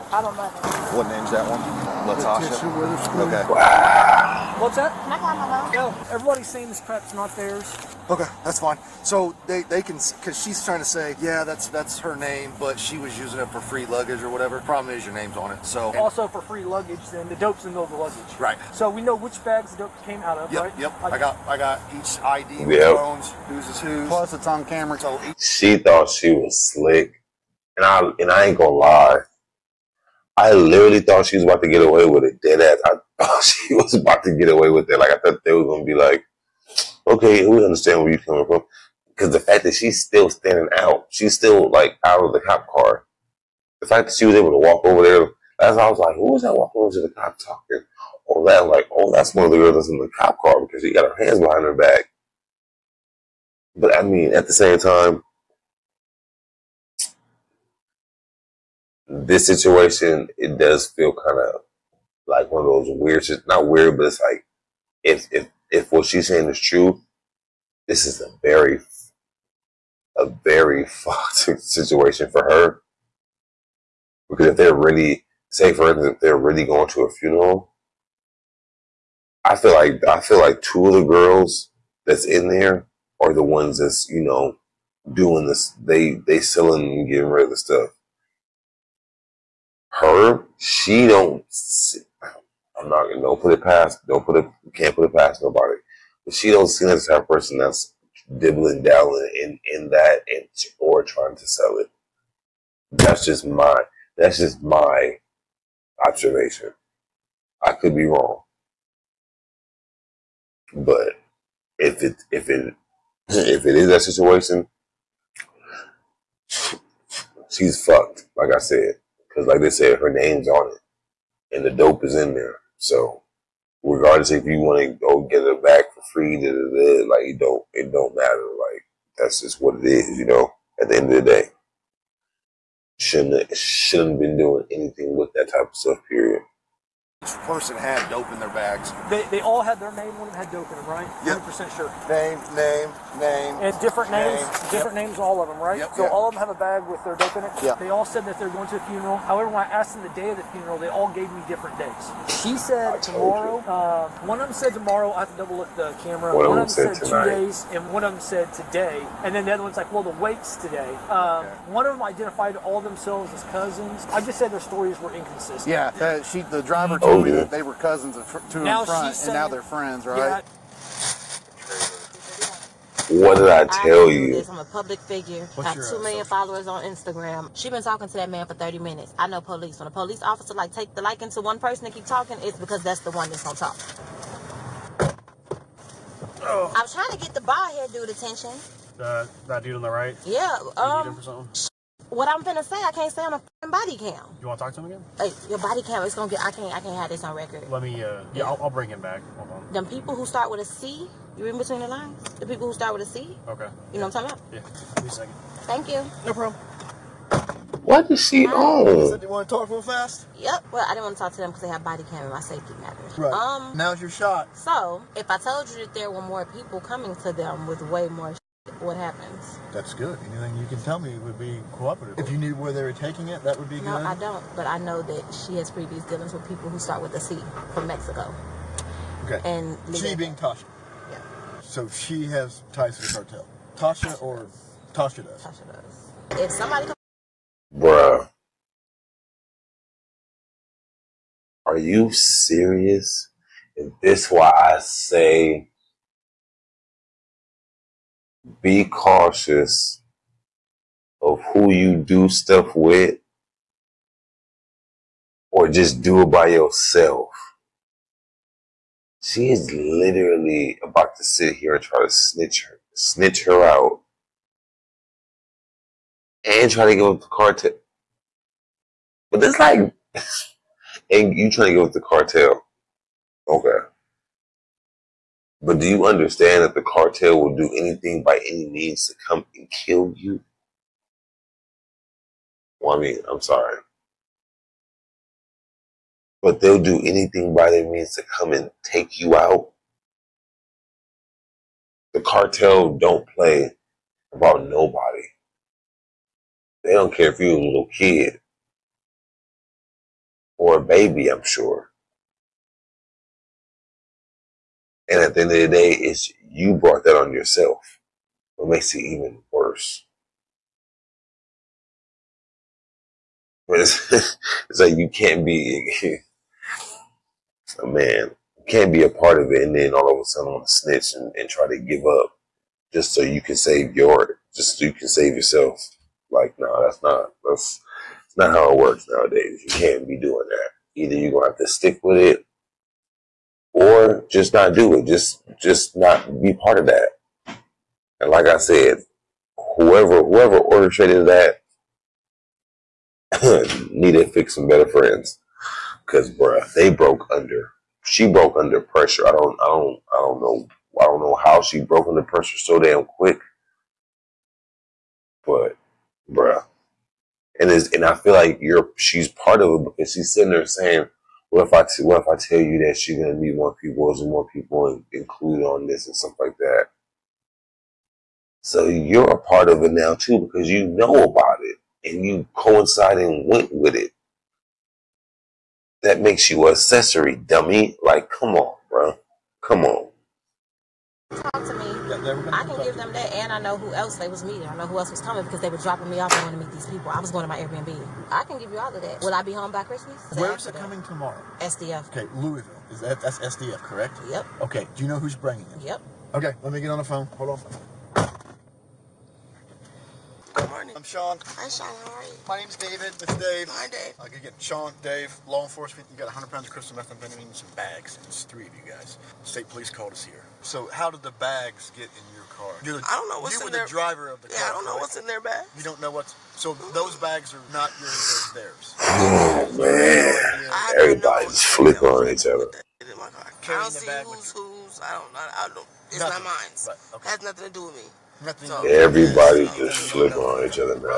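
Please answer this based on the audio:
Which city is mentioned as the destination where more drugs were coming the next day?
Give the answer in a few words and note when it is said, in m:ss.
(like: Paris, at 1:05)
Louisville, at 6:32.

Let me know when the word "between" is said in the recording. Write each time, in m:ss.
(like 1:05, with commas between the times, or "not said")
3:21.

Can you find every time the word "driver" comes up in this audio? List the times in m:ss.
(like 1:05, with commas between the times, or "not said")
2:46, 6:53.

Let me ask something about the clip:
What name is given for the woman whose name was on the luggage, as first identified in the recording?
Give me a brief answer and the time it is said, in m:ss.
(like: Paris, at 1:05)
Latasha, at 0:02.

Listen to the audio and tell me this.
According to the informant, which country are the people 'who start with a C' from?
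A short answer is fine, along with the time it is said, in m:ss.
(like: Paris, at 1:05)
Mexico, at 3:47.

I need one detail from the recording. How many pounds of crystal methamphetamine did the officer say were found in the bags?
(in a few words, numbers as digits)
100.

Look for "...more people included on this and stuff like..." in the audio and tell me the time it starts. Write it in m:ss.
6:04.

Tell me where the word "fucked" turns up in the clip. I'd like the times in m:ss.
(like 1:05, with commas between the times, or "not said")
1:10, 1:57.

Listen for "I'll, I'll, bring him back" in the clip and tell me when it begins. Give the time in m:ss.
3:18.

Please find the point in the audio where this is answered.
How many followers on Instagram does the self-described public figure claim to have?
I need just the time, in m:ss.
2:55.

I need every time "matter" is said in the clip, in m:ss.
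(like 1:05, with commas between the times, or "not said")
2:08, 3:32.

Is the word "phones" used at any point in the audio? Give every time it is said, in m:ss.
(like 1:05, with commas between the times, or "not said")
0:22, 6:37.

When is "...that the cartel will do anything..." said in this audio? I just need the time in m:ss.
4:36.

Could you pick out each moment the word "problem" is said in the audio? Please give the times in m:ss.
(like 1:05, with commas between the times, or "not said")
0:14, 3:26.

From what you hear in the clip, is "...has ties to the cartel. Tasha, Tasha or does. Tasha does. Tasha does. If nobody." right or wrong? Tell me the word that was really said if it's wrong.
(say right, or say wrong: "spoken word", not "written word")
wrong: "somebody", not "nobody".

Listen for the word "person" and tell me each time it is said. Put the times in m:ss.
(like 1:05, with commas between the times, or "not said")
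1:37, 2:17, 3:01.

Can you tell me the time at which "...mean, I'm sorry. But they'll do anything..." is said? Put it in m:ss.
4:43.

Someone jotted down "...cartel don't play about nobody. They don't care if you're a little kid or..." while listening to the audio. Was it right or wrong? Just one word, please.
right.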